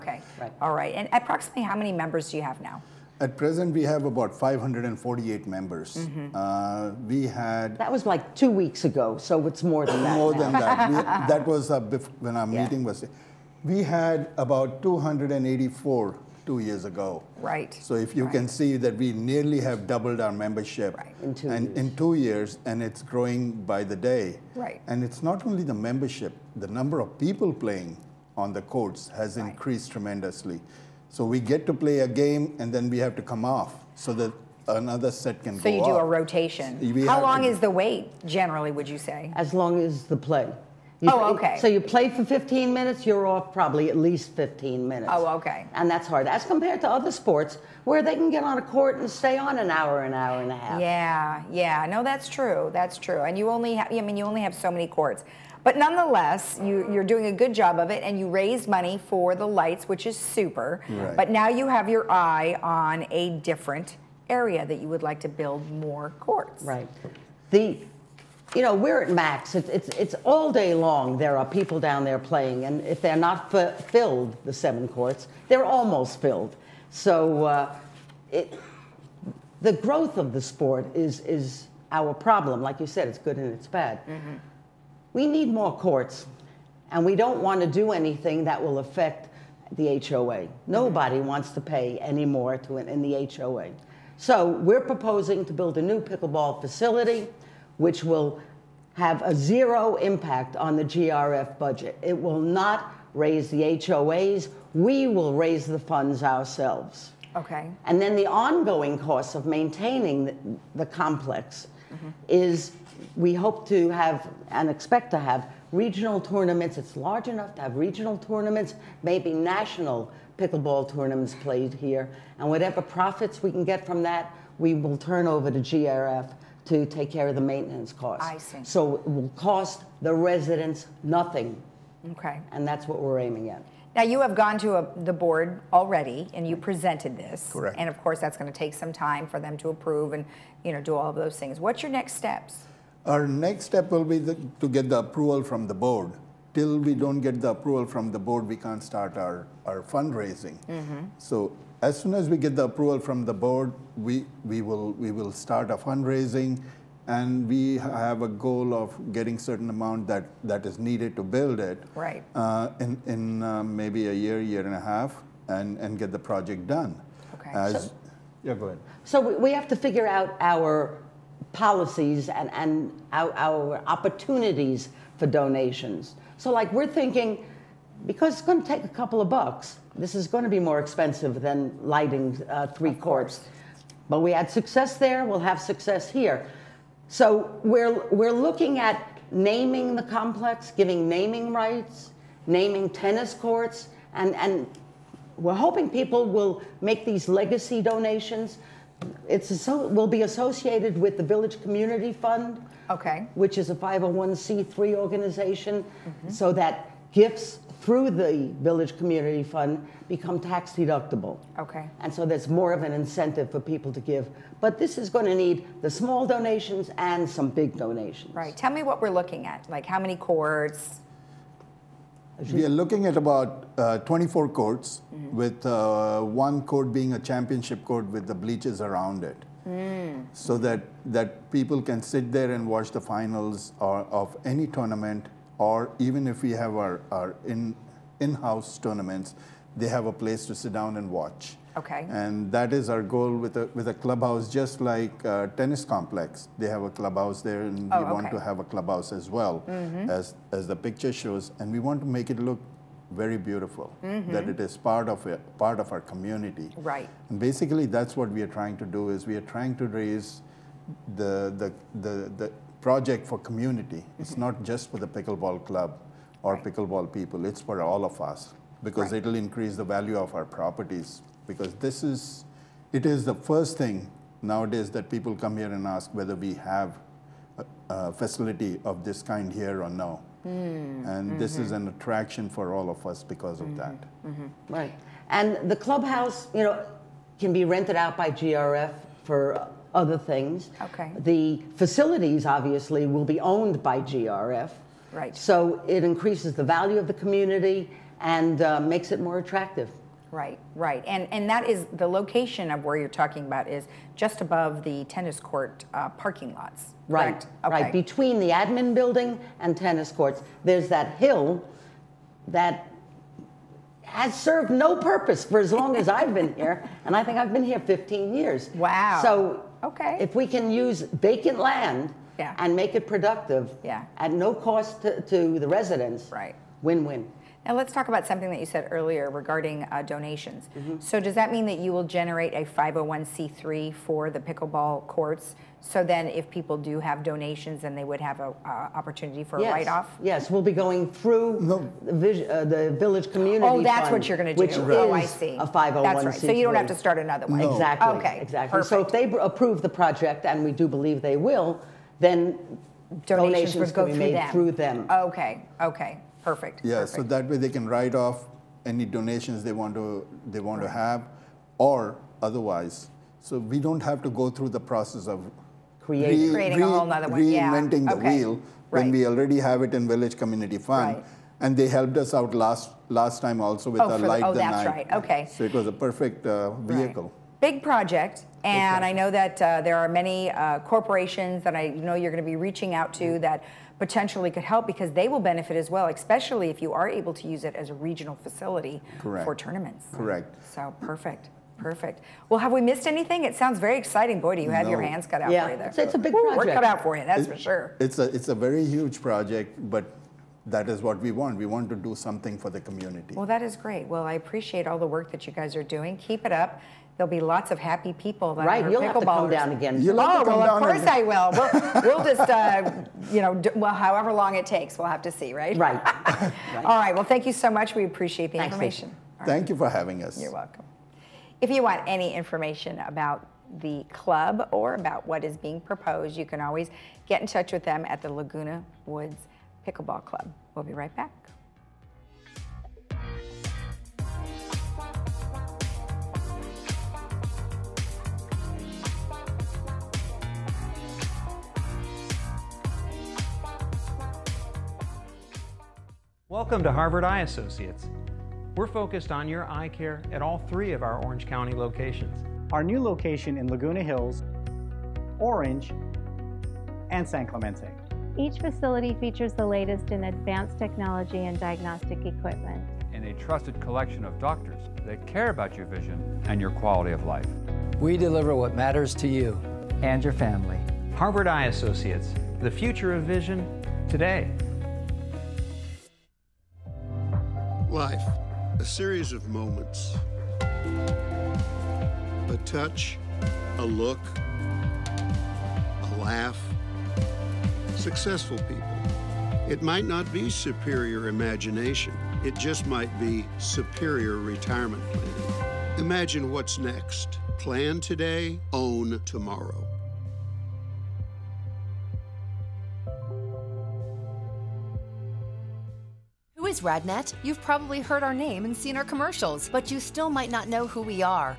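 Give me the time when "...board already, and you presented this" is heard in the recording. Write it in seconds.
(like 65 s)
135 s.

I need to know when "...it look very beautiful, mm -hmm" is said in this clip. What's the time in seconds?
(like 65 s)
252 s.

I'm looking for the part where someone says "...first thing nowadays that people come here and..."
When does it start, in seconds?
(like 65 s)
273 s.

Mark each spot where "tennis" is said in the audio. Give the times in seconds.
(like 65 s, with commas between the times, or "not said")
192 s, 245 s, 305 s, 309 s.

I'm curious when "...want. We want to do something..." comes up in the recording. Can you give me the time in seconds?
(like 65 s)
401 s.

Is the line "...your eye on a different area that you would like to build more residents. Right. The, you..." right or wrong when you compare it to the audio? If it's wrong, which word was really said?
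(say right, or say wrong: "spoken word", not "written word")
wrong: "courts", not "residents".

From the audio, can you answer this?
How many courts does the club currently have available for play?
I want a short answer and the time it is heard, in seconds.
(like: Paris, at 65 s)
7, at 74 s.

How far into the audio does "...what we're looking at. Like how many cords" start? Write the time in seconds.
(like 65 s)
218 s.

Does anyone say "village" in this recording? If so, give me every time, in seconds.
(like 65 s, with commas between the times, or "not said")
201 s, 208 s, 343 s, 370 s.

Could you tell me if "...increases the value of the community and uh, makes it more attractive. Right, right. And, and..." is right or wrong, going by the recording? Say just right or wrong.
right.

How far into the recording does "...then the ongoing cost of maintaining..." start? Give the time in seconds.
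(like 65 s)
108 s.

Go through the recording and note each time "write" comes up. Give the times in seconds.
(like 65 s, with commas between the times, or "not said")
339 s, 357 s.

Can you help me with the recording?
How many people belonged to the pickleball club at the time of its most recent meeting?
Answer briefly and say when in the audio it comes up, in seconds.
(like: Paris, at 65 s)
548, at 4 s.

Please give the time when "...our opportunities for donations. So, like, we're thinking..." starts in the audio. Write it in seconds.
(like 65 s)
173 s.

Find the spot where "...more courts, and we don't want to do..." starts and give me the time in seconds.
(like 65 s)
85 s.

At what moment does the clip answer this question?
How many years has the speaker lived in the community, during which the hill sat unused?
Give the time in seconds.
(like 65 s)
317 s.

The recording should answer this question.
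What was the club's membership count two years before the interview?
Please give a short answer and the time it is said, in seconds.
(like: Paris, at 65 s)
284, at 14 s.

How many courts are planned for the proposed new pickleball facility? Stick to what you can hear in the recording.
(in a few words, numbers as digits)
24.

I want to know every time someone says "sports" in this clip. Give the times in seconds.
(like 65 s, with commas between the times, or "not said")
47 s, 80 s.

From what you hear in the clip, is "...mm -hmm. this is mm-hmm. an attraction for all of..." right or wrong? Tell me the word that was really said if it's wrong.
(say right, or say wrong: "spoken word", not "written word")
right.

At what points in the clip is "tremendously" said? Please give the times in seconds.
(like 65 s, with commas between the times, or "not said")
29 s.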